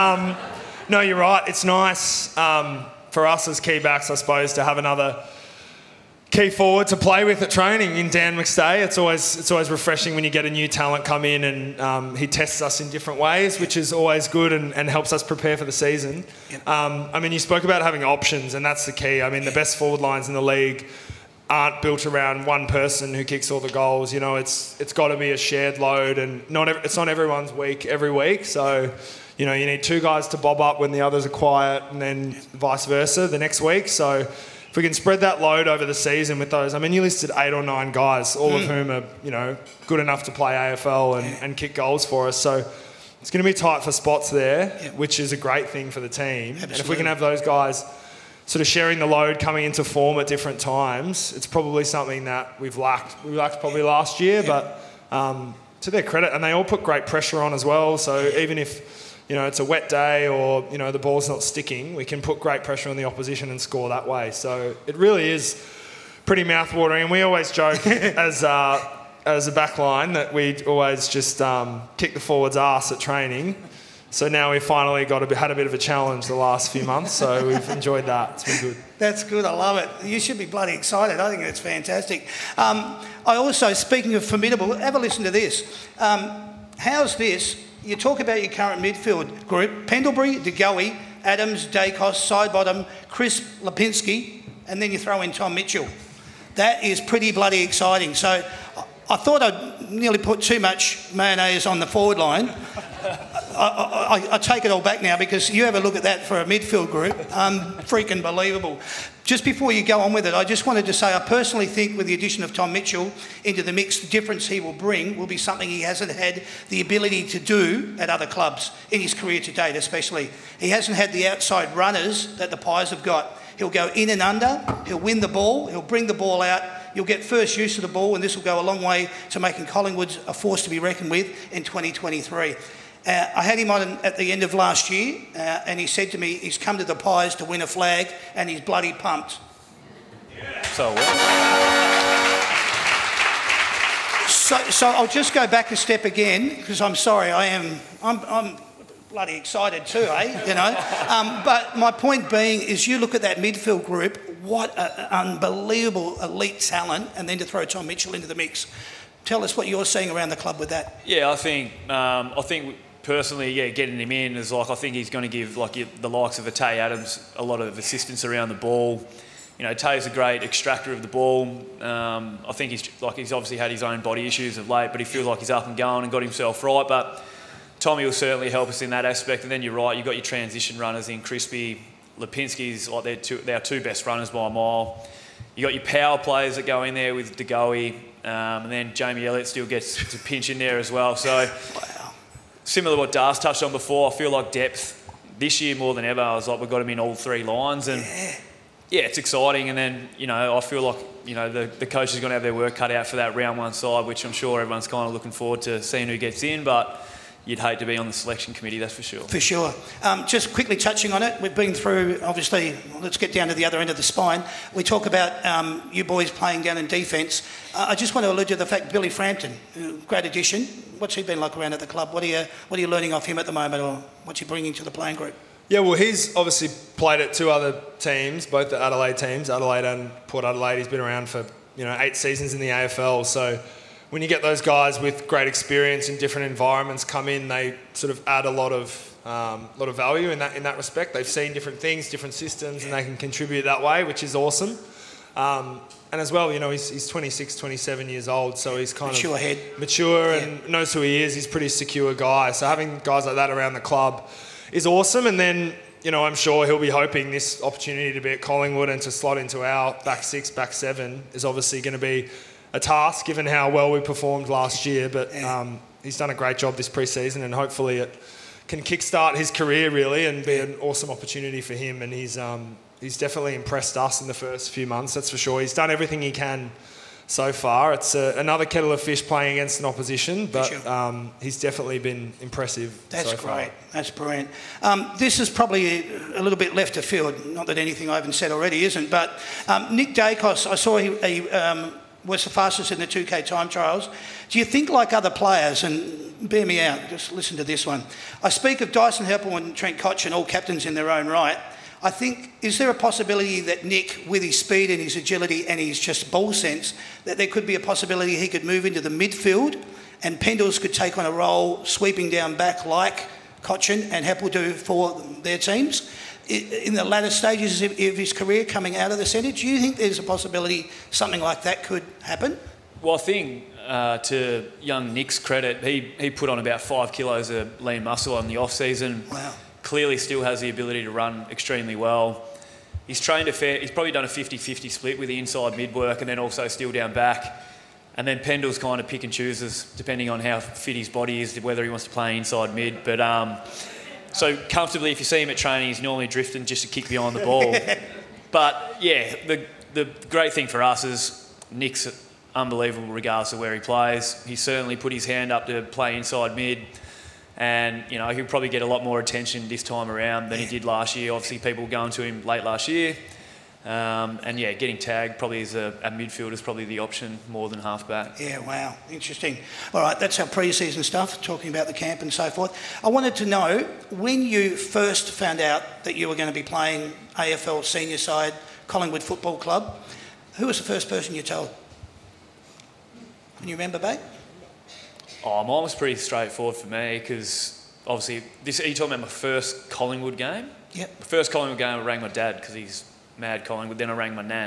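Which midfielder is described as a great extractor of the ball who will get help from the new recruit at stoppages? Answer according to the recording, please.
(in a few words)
Tay Adams.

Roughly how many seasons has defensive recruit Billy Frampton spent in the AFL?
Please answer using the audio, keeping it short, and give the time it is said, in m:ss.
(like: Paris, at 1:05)
8, at 3:51.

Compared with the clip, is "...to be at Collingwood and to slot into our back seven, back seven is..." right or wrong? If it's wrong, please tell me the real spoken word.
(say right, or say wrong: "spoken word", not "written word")
wrong: "six", not "seven".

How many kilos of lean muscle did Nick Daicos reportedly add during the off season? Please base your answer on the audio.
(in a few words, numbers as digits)
5.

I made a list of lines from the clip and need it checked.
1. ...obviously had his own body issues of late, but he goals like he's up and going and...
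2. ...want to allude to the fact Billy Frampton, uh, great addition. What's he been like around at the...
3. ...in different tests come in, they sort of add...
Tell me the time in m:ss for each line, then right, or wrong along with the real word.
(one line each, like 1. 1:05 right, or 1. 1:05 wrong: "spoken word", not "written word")
1. 2:53 wrong: "feels", not "goals"
2. 3:38 right
3. 3:56 wrong: "environments", not "tests".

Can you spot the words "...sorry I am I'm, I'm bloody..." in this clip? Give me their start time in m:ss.
2:26.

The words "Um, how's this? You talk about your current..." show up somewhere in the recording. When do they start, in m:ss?
1:25.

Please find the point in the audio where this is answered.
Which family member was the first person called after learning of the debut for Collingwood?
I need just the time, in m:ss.
6:32.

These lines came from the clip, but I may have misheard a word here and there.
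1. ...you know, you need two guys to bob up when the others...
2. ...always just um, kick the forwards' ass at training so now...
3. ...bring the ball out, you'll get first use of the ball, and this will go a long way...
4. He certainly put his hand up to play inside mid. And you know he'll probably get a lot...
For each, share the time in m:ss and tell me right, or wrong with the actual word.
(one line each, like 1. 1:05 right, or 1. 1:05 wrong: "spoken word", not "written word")
1. 0:29 right
2. 1:10 right
3. 2:05 right
4. 5:54 right.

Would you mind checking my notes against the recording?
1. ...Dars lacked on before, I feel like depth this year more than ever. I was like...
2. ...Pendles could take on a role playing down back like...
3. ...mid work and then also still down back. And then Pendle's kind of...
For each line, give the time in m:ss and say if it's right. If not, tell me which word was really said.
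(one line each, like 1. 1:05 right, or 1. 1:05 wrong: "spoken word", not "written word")
1. 3:13 wrong: "touched", not "lacked"
2. 5:10 wrong: "sweeping", not "playing"
3. 5:35 right.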